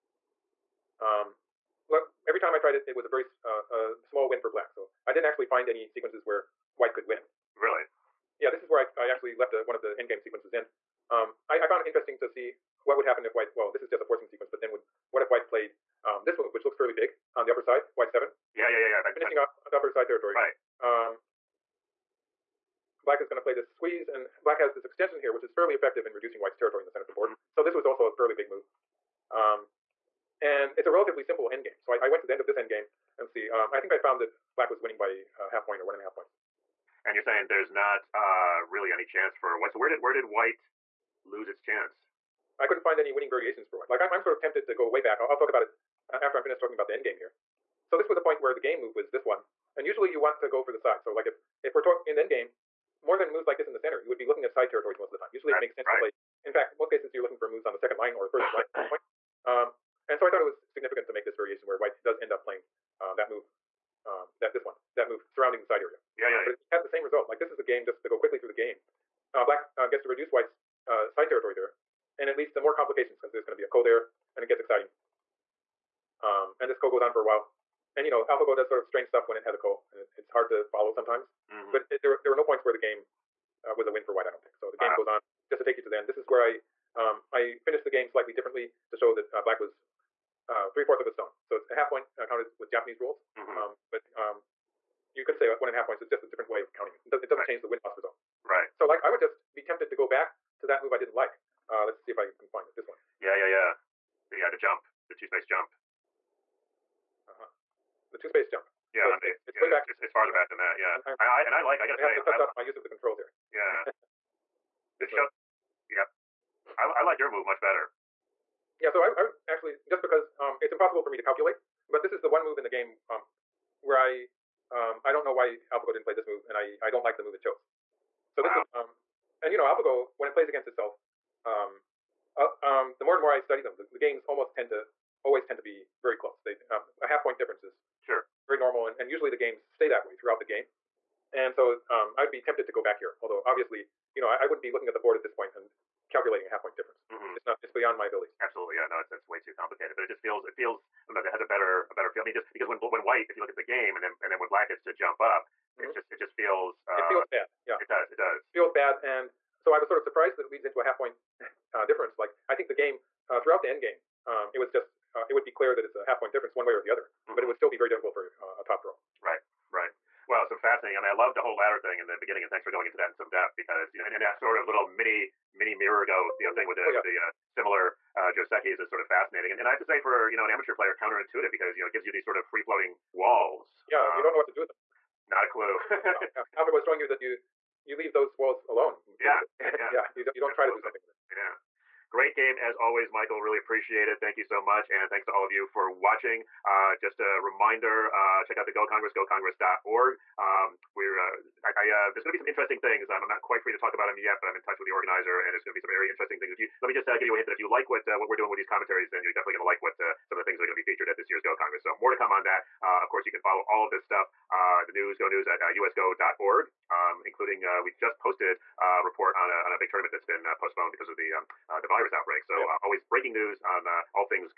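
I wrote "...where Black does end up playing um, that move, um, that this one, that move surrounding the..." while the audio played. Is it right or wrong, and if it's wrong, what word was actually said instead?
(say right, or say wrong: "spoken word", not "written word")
wrong: "White", not "Black".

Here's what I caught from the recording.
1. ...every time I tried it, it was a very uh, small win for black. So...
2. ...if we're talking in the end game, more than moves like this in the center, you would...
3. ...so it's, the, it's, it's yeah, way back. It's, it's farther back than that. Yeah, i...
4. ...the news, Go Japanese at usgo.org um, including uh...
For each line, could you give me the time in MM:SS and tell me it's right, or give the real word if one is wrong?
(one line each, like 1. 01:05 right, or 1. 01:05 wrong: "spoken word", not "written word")
1. 00:02 right
2. 00:51 right
3. 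01:49 right
4. 03:34 wrong: "News", not "Japanese".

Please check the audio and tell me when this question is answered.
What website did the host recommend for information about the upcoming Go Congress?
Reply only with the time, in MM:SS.
03:19.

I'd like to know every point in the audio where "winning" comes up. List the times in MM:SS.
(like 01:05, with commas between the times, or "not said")
00:34, 00:43.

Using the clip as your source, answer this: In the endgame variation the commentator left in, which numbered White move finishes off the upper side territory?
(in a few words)
White 7.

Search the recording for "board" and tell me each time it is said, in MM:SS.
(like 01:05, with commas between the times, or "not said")
00:27, 02:24.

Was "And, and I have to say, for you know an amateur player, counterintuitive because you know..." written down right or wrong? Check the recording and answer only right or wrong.
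right.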